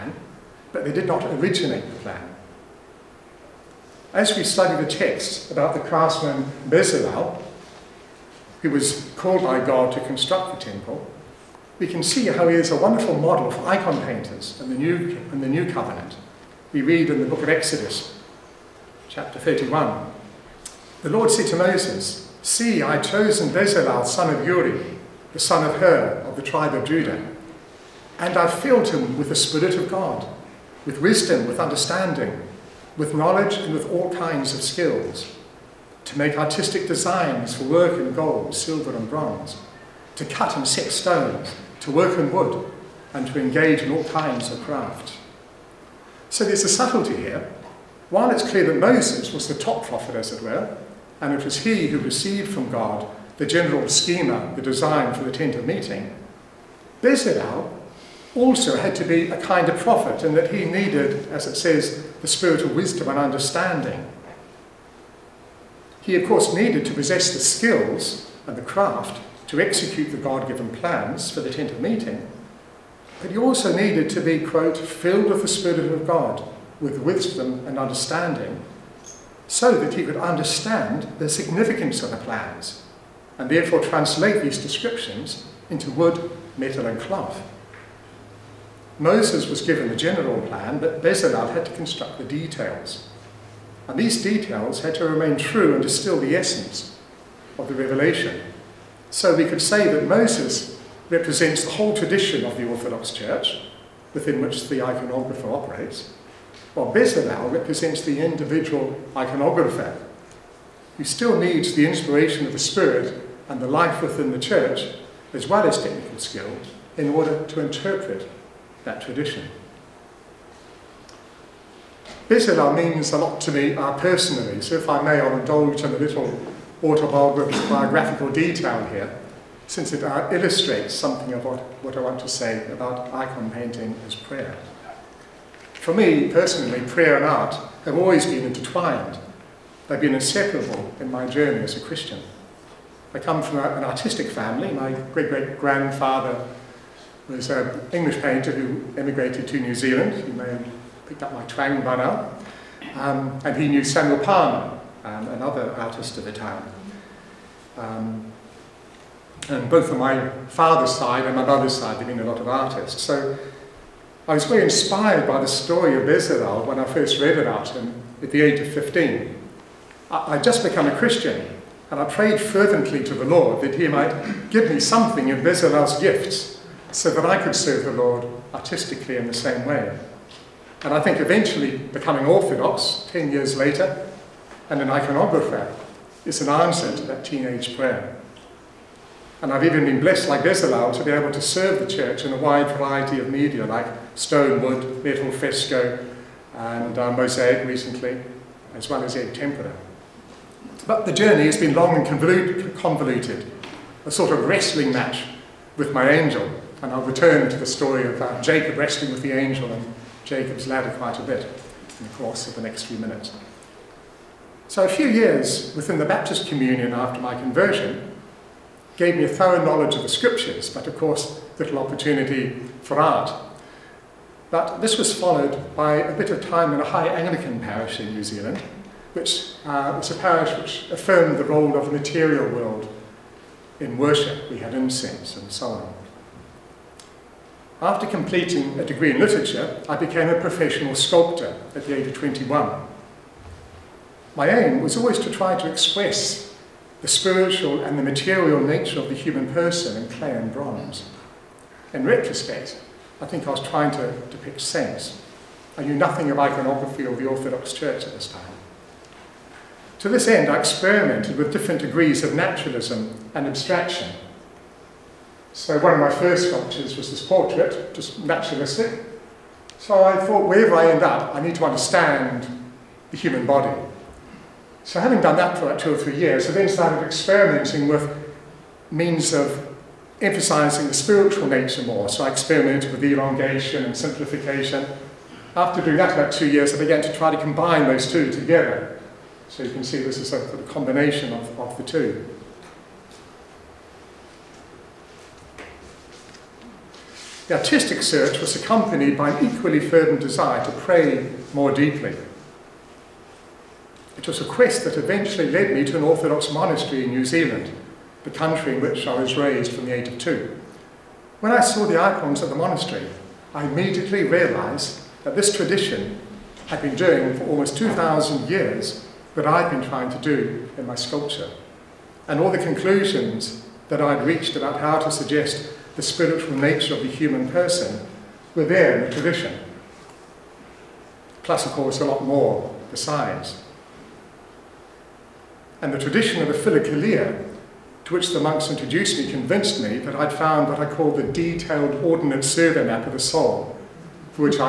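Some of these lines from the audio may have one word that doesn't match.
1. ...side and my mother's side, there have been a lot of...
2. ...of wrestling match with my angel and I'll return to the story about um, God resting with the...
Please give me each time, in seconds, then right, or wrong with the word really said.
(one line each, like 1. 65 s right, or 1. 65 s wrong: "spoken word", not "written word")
1. 160 s right
2. 204 s wrong: "Jacob", not "God".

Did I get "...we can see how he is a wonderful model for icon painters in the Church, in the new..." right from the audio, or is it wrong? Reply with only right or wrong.
wrong.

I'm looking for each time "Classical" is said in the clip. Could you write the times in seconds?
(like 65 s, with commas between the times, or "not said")
331 s.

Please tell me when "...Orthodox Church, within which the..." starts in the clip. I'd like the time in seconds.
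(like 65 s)
102 s.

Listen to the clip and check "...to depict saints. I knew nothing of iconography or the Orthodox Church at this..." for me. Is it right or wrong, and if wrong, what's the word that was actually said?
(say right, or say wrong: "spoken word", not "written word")
right.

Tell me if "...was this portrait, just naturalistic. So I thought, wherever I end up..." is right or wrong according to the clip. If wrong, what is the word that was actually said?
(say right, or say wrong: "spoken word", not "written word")
right.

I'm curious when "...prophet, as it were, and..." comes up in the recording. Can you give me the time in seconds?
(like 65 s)
49 s.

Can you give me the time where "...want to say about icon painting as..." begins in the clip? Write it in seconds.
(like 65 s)
132 s.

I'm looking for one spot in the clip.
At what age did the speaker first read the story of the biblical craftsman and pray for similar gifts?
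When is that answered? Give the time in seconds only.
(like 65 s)
168 s.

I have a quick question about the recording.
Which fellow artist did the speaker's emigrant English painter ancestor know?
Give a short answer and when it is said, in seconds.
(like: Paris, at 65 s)
Samuel Palmer, at 153 s.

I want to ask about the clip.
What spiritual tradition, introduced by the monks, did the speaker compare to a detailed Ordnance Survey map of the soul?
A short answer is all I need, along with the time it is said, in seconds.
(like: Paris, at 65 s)
The Philokalia, at 336 s.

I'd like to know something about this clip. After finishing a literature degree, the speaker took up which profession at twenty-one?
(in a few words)
Sculptor.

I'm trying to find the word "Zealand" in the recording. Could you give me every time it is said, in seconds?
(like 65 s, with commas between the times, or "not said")
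149 s, 228 s, 307 s.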